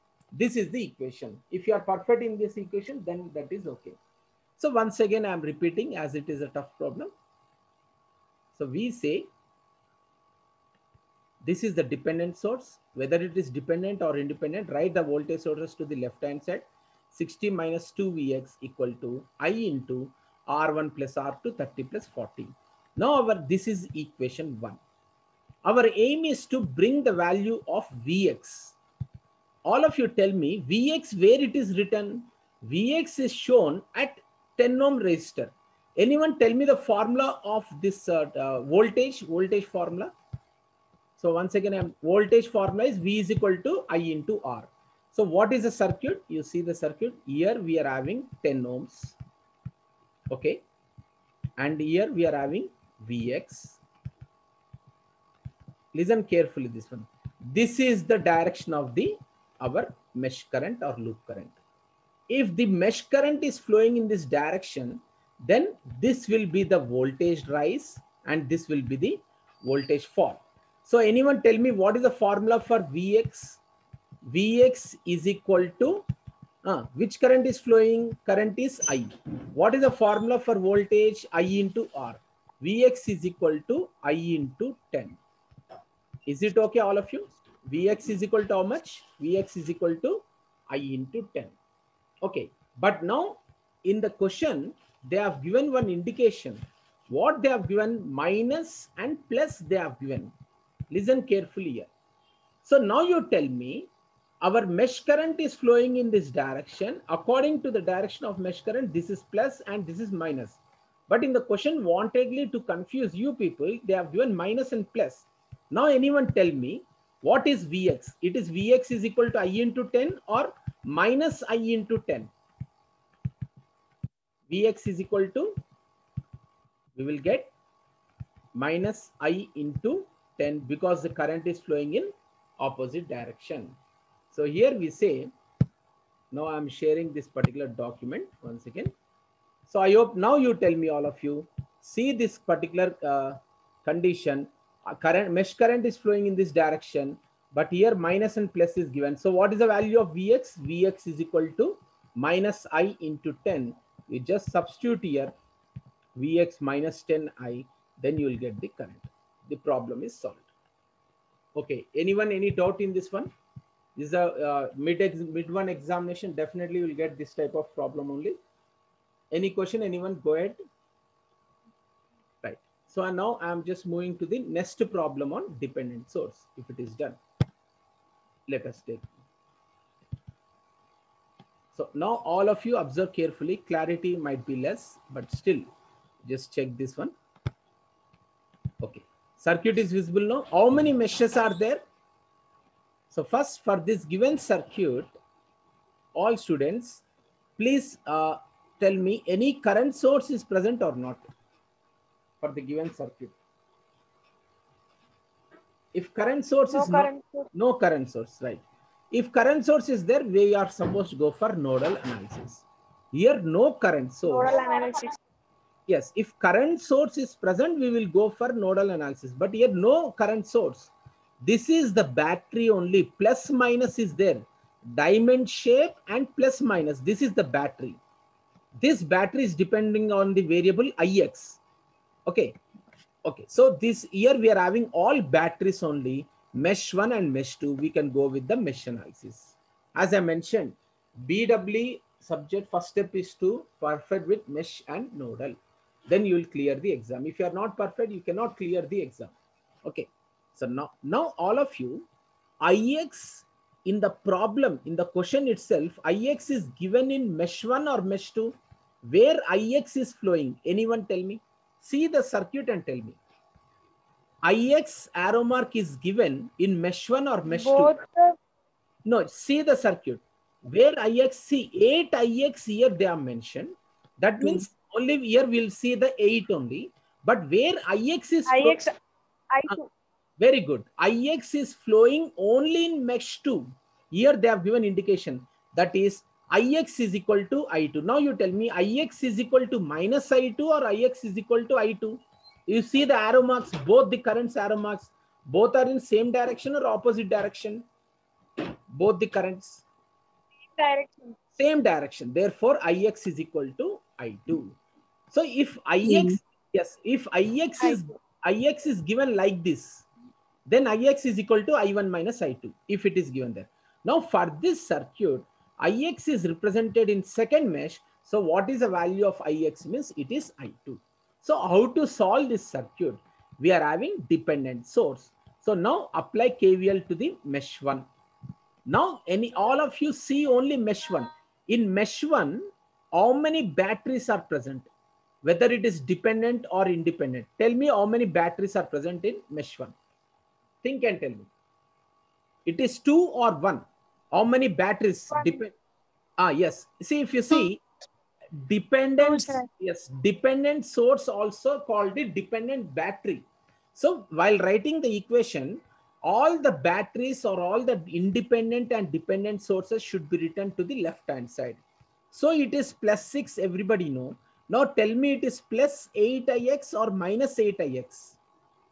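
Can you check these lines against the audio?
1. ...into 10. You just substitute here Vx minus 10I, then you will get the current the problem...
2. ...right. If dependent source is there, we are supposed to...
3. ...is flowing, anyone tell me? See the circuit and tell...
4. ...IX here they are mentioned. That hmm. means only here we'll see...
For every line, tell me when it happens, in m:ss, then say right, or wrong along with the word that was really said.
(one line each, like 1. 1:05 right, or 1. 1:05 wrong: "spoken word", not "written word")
1. 2:33 right
2. 3:28 wrong: "current", not "dependent"
3. 4:19 right
4. 4:32 right.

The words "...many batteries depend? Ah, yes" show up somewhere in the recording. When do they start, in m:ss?
5:44.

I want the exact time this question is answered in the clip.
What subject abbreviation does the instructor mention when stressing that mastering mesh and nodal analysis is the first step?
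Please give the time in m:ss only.
4:01.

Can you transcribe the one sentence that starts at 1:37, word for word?
What they have given minus and plus they have given.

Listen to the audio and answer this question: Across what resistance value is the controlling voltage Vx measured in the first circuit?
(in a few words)
10 ohms.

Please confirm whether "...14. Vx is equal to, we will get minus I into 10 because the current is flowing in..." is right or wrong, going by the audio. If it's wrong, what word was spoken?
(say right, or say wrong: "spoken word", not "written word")
wrong: "10", not "14".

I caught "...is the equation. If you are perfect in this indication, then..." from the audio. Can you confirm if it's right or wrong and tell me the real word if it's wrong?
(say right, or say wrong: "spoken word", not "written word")
wrong: "equation", not "indication".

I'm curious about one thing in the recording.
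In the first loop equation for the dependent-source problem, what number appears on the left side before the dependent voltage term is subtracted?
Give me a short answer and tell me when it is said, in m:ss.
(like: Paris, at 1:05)
60, at 0:17.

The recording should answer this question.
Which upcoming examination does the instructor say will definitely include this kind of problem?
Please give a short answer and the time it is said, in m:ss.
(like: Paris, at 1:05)
mid one examination, at 2:45.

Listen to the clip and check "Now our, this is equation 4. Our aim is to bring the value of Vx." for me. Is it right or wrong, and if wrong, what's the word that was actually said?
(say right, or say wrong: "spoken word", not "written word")
wrong: "1", not "4".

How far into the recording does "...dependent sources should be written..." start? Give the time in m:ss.
5:59.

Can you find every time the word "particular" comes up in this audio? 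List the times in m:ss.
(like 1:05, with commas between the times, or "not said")
2:17, 2:22.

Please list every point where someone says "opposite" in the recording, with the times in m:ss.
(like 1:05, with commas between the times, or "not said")
2:12, 4:56.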